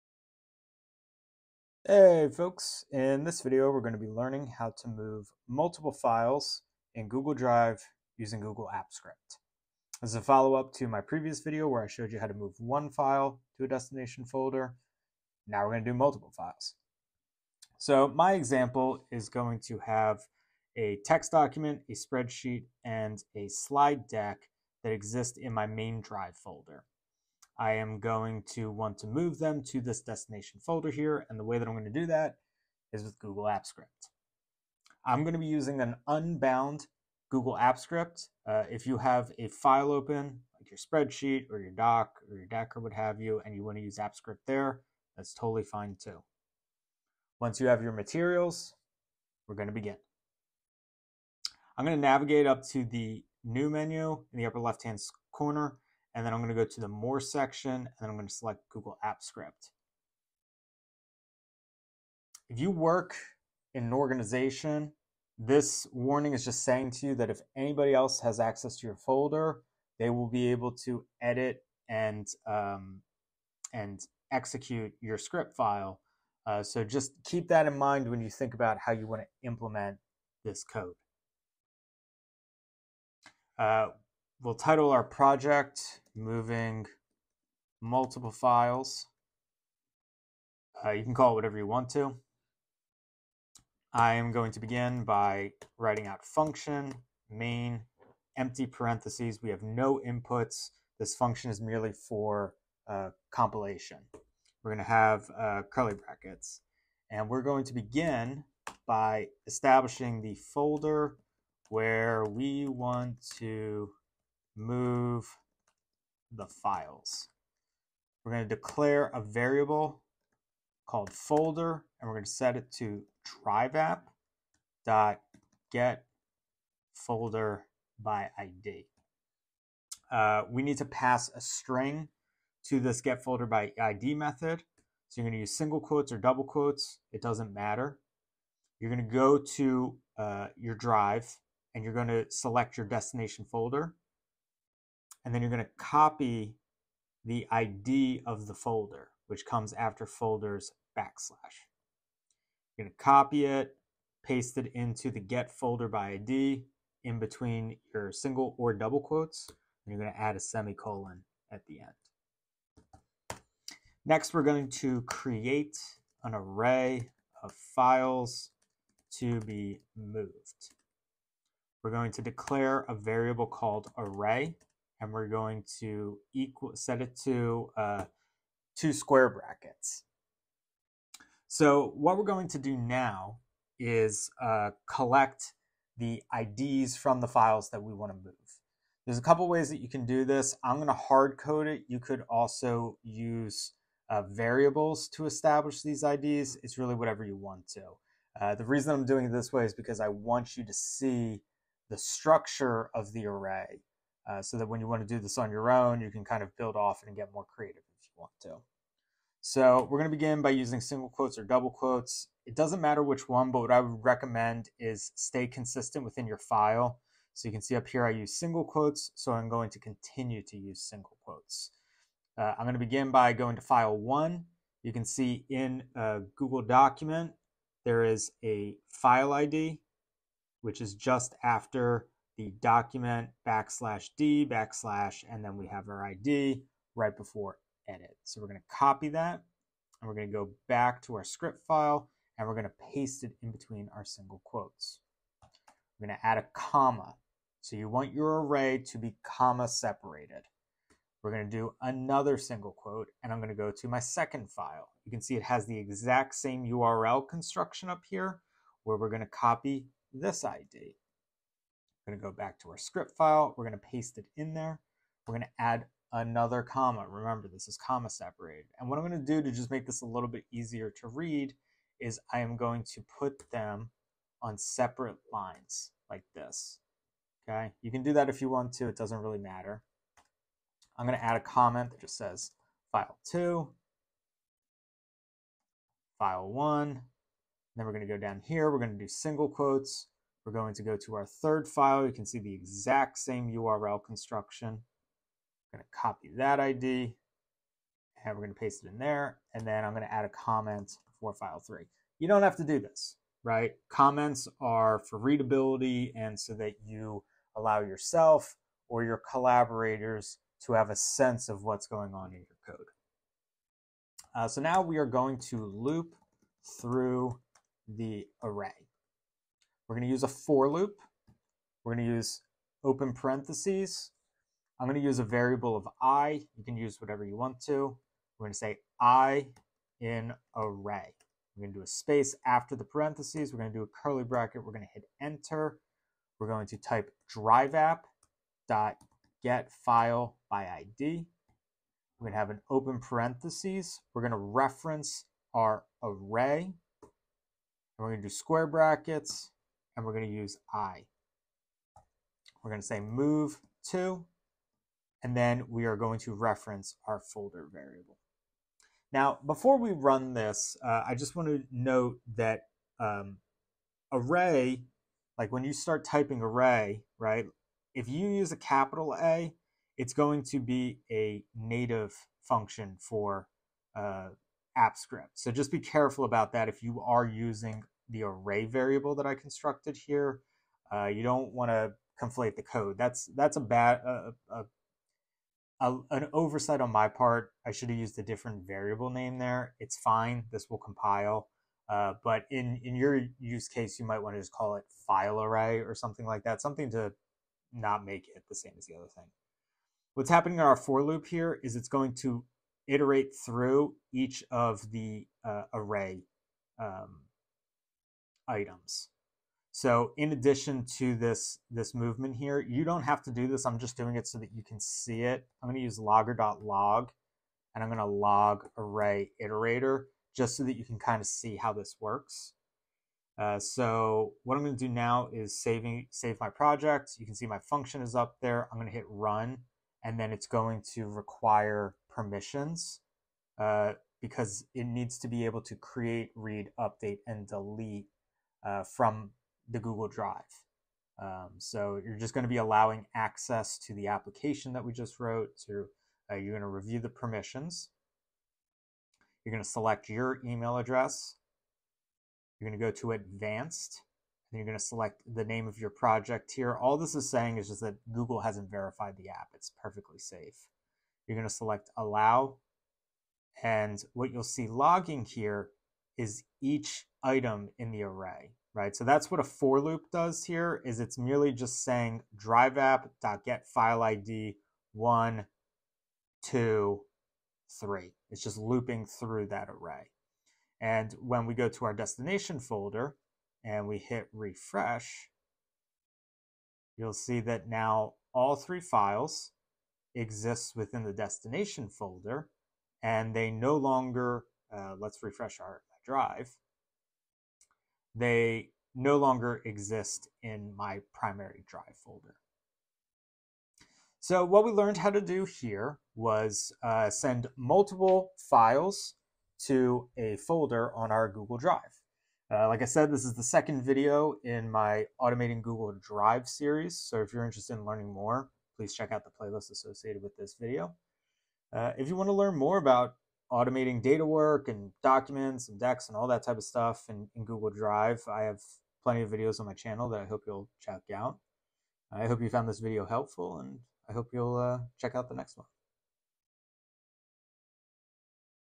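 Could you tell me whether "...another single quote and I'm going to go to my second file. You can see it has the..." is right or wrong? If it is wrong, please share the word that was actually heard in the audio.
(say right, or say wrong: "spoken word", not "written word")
right.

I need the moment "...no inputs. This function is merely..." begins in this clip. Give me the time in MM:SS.
01:39.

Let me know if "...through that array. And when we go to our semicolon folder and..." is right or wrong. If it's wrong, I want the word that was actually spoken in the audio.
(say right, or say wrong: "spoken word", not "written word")
wrong: "destination", not "semicolon".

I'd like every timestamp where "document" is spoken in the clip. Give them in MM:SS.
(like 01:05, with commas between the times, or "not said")
00:21, 03:46, 03:52, 08:45.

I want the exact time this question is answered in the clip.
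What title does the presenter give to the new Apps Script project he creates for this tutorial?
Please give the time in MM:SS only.
01:26.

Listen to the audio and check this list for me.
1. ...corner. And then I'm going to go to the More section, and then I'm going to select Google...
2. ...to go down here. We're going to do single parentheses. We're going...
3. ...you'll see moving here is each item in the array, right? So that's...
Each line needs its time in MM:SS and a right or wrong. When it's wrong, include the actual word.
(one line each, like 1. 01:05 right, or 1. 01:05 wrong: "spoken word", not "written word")
1. 00:55 right
2. 04:48 wrong: "quotes", not "parentheses"
3. 07:44 wrong: "logging", not "moving".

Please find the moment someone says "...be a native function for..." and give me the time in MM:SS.
06:10.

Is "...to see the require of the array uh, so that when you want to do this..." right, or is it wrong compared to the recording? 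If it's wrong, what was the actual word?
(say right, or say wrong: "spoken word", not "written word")
wrong: "structure", not "require".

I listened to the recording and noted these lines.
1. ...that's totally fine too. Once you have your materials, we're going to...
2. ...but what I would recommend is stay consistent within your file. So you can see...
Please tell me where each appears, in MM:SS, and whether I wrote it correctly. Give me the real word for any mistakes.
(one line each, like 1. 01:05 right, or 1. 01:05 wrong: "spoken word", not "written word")
1. 00:45 right
2. 03:33 right.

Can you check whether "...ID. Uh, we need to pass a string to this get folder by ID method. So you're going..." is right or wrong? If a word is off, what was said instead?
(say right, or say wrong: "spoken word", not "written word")
right.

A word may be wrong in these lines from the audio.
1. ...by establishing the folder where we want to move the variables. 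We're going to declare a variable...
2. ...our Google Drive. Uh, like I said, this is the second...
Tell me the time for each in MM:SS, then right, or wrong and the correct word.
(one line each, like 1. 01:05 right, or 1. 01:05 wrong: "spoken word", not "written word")
1. 01:48 wrong: "files", not "variables"
2. 08:31 right.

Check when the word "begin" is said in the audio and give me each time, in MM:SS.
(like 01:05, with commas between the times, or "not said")
00:49, 01:34, 01:47, 03:30, 03:42.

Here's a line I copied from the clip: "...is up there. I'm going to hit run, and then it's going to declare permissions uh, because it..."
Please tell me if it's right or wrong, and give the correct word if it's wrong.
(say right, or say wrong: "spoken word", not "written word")
wrong: "require", not "declare".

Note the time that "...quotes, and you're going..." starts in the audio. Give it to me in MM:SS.
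02:38.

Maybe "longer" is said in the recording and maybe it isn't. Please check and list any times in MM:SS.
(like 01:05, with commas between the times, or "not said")
08:13, 08:19.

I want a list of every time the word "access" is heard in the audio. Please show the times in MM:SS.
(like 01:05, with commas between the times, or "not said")
01:08, 07:23.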